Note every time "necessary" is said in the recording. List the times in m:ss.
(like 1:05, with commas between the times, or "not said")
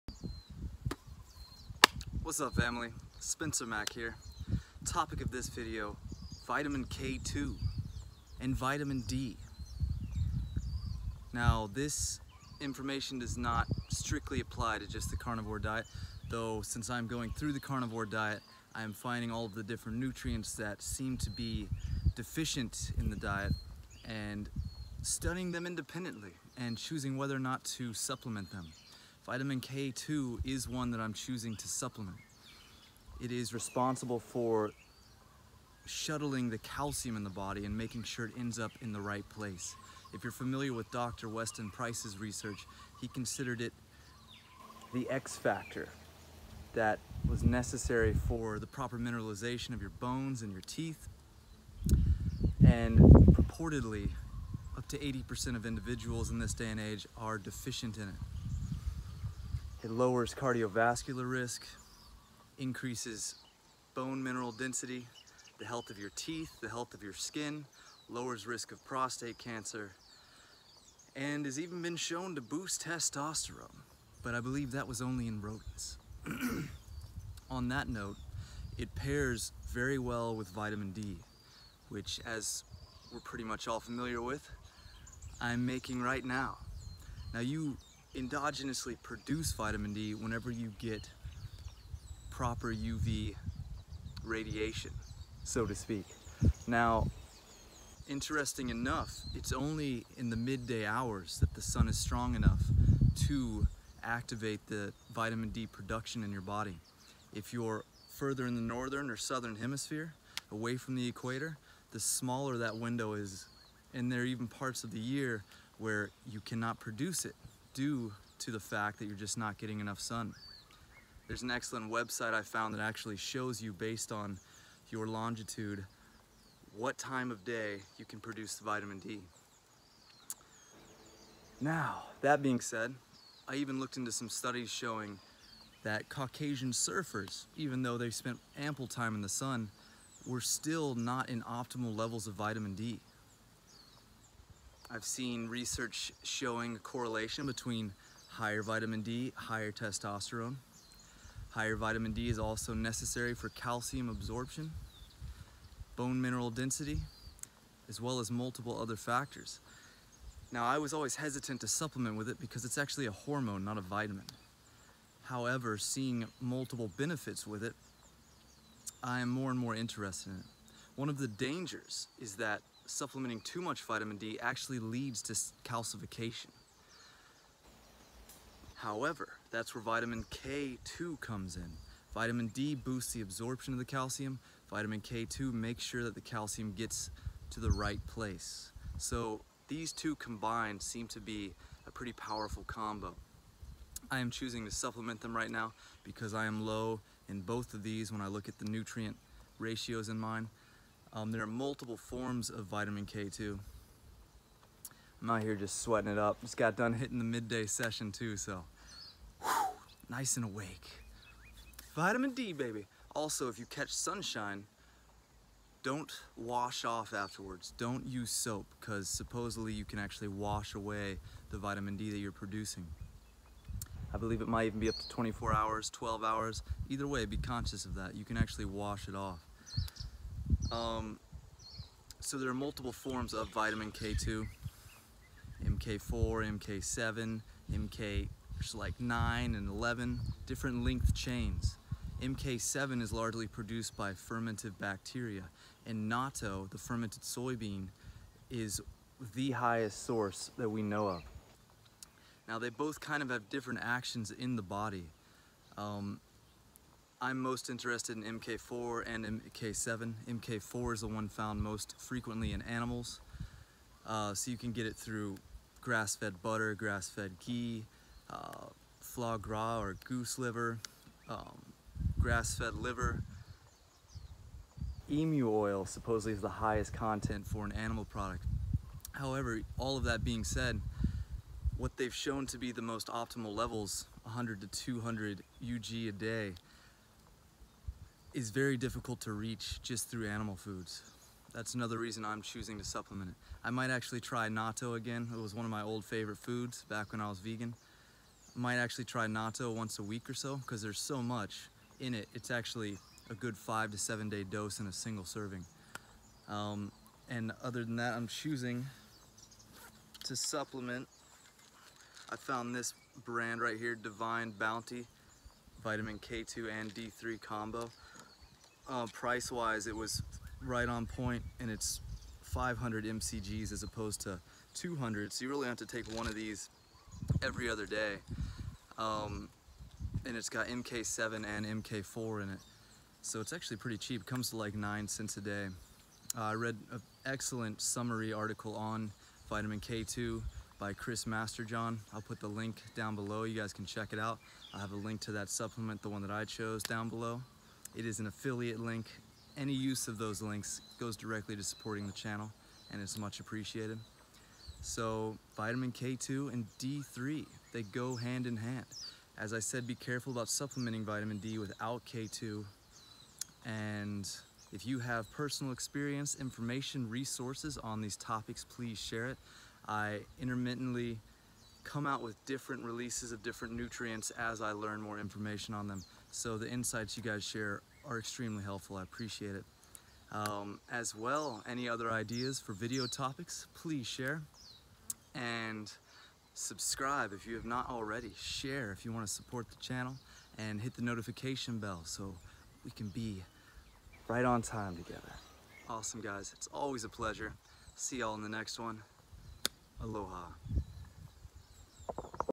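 0:47, 2:32.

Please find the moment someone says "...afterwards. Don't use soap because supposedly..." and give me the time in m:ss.
3:37.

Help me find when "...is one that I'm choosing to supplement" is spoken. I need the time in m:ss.
0:30.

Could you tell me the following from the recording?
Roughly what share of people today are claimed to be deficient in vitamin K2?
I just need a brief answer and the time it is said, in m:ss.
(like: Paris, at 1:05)
80%, at 0:54.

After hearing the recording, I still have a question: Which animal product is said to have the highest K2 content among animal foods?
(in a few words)
Emu oil.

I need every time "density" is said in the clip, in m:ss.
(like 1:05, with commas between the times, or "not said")
1:04, 2:36.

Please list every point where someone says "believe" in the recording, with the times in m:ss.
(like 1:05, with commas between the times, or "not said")
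1:14, 3:44.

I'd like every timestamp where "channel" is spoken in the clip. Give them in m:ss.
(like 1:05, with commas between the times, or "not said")
5:52, 6:29.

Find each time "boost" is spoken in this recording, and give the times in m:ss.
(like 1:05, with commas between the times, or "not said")
1:12, 3:02.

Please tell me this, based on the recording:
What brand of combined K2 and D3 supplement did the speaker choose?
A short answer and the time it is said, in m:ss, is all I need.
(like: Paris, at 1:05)
Divine Bounty, at 5:13.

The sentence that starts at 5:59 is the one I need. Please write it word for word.
As I said, be careful about supplementing vitamin D without K2.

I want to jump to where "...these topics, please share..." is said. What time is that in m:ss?
6:08.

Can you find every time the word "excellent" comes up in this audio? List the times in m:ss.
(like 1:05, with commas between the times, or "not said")
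2:01, 5:37.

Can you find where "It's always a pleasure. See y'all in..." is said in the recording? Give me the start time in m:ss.
6:36.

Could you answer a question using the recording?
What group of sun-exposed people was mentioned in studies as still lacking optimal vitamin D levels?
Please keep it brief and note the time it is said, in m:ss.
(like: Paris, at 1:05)
Caucasian surfers, at 2:16.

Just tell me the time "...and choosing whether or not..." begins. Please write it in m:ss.
0:26.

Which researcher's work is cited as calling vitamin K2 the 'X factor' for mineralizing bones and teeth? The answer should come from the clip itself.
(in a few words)
Weston Price.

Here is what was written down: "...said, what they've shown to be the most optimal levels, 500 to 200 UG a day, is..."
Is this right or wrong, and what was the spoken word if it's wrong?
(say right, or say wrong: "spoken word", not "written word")
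wrong: "100", not "500".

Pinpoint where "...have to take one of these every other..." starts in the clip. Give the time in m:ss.
5:25.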